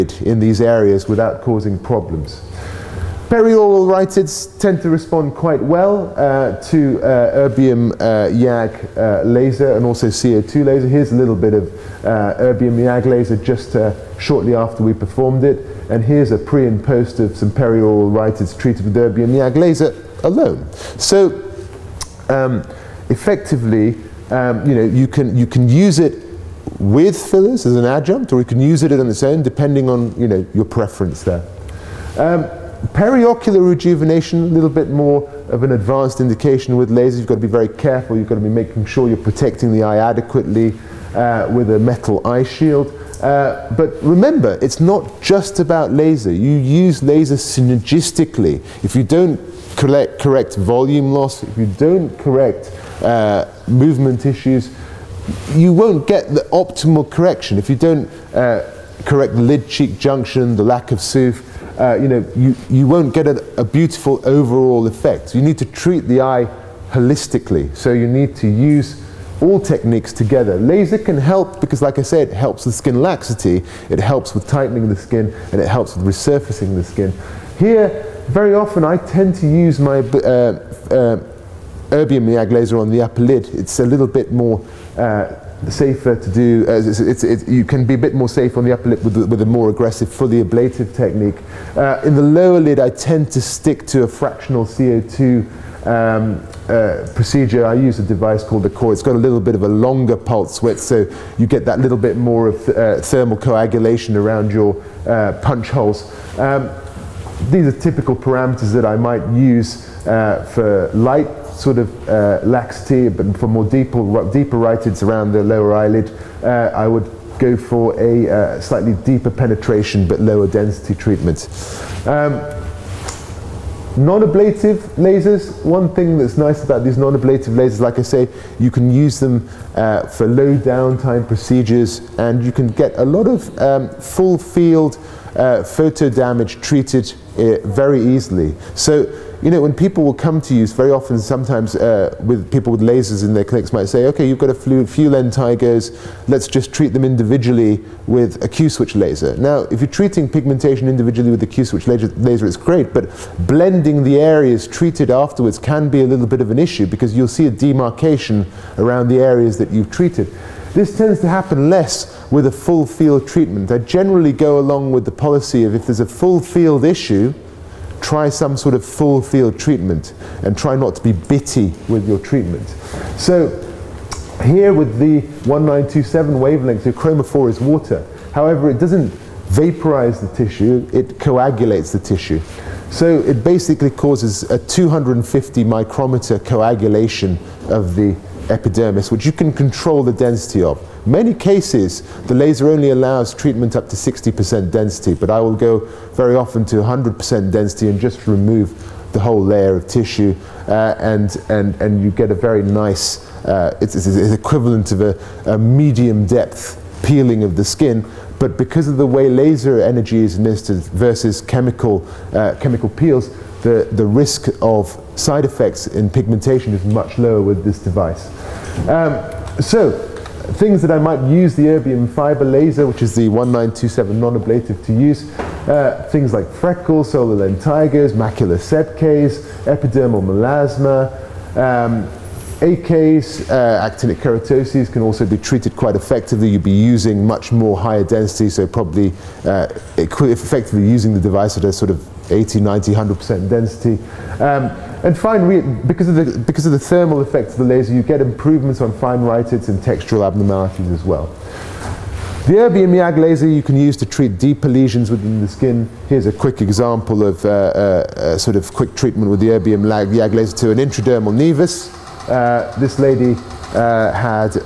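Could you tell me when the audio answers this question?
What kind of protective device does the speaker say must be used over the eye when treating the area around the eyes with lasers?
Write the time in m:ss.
0:41.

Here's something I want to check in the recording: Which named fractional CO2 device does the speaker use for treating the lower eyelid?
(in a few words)
CO2RE.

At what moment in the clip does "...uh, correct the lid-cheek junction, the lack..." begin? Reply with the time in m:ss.
0:58.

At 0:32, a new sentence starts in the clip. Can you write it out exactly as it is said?
Um, periocular rejuvenation, a little bit more of an advanced indication with lasers.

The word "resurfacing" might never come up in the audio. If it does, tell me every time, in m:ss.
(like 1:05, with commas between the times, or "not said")
1:16.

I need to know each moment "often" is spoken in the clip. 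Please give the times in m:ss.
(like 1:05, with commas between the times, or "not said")
1:18, 2:20, 3:16.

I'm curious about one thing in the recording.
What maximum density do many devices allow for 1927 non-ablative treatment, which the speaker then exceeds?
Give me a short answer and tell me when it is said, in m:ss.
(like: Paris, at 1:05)
60%, at 3:13.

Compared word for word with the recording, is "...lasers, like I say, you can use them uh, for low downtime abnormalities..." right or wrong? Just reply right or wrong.
wrong.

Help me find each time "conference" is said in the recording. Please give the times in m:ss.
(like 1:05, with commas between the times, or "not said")
not said.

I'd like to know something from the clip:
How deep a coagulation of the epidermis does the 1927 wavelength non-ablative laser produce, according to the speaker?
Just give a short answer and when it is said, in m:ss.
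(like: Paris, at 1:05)
250 micrometers, at 3:04.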